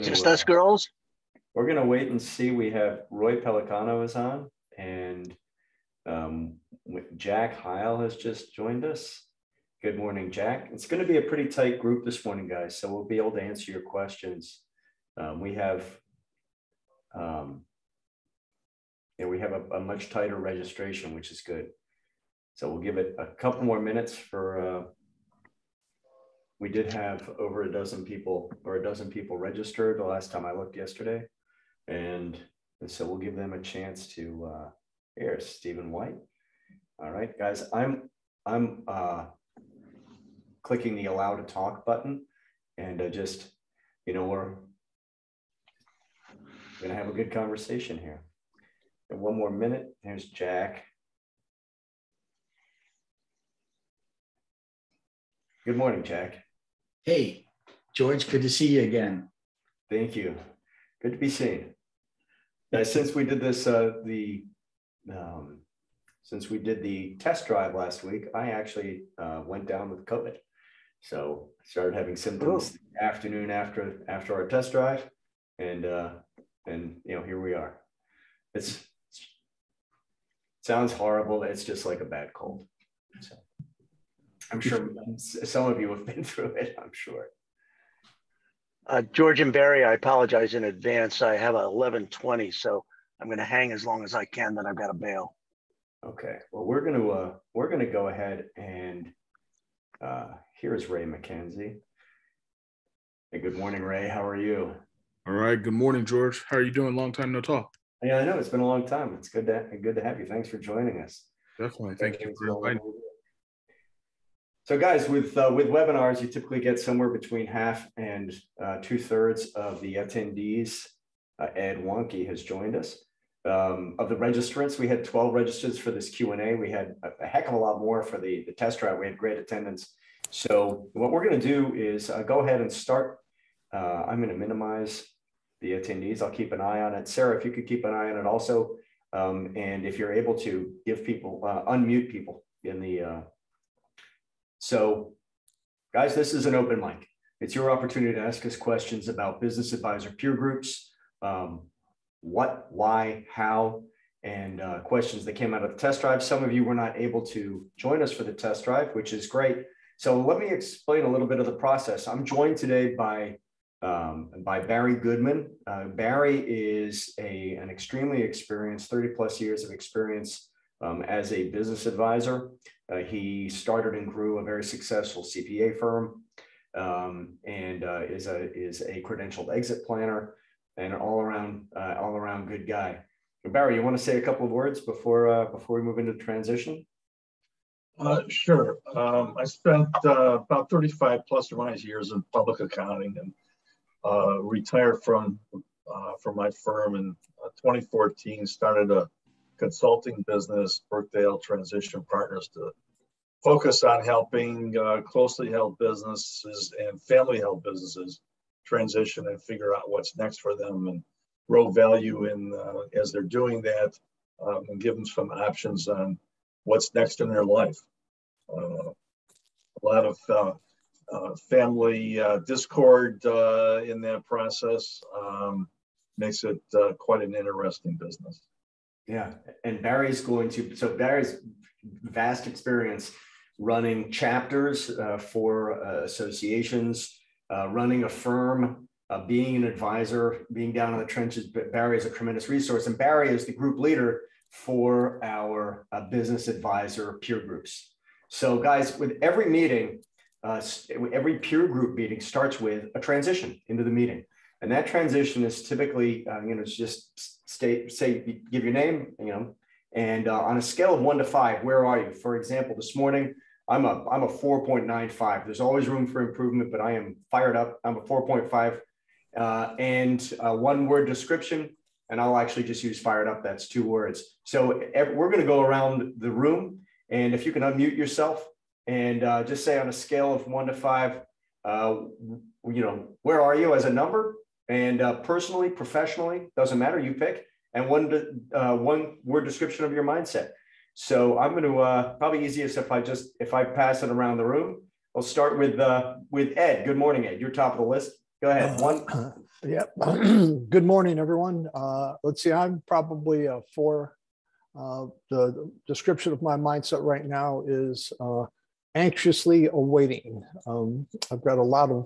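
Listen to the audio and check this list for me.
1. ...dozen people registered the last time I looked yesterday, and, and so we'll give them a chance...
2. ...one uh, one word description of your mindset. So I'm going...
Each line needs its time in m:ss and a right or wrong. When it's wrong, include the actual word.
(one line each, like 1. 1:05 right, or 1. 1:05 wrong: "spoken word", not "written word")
1. 0:28 right
2. 4:47 right.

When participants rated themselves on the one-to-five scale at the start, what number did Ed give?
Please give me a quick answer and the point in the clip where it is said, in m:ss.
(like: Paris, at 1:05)
4, at 5:03.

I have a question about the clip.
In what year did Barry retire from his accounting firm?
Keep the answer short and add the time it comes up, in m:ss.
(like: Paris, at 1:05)
2014, at 3:17.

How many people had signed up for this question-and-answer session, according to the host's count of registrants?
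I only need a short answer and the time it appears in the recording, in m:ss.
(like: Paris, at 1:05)
12, at 2:05.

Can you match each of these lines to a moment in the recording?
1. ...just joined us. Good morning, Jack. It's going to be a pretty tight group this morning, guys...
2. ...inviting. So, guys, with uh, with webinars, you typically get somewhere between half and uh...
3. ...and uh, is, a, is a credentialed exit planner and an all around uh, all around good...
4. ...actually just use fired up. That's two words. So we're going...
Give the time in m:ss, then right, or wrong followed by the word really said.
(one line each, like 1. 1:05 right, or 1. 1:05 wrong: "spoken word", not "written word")
1. 0:08 right
2. 1:52 right
3. 2:57 right
4. 4:32 right.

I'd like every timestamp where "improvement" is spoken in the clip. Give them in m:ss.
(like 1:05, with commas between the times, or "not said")
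4:26.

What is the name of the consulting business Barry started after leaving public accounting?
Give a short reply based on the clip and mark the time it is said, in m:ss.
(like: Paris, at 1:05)
Brookdale Transition Partners, at 3:20.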